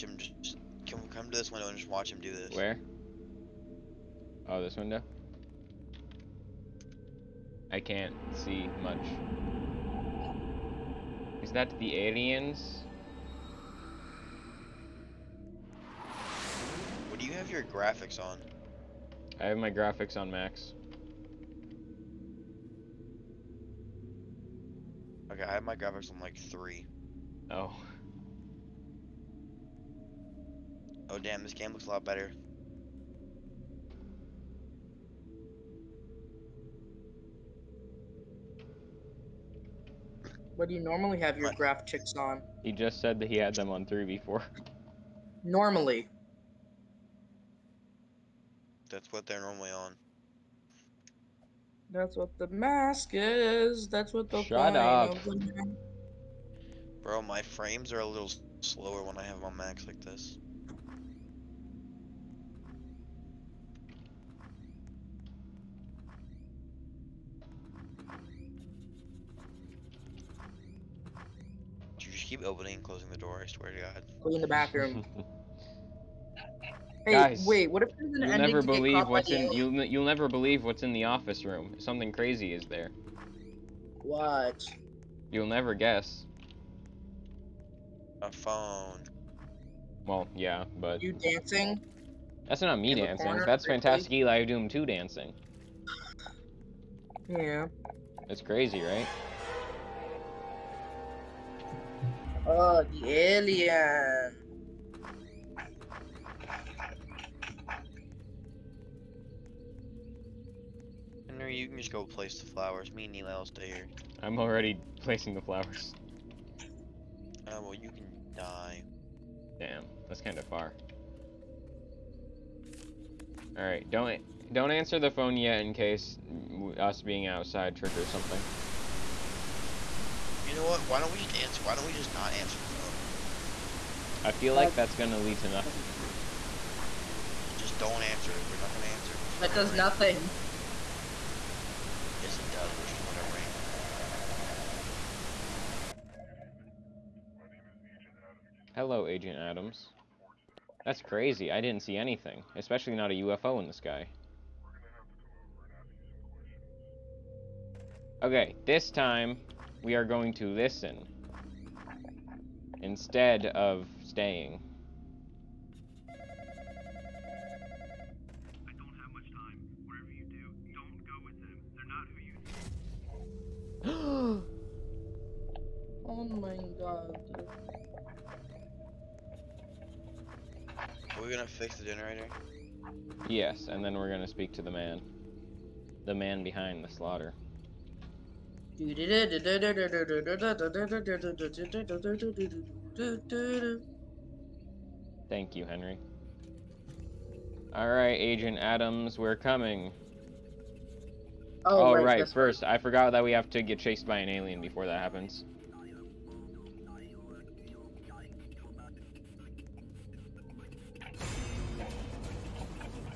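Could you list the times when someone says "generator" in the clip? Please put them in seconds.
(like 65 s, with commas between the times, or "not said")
181 s.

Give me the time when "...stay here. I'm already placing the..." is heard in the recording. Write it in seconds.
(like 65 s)
113 s.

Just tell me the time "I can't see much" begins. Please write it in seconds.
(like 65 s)
7 s.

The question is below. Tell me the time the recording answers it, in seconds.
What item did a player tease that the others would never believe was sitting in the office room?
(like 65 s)
88 s.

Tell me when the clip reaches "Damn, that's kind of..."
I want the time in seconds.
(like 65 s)
119 s.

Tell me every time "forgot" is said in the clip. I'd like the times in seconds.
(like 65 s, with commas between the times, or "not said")
202 s.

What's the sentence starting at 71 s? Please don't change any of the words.
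You just keep opening and closing the door, I swear to God.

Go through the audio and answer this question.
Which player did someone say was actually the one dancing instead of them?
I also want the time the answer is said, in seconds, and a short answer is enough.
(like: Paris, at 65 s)
Fantastic Eli Doom 2, at 93 s.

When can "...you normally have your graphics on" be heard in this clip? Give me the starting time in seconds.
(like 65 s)
40 s.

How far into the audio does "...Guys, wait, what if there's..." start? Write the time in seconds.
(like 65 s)
77 s.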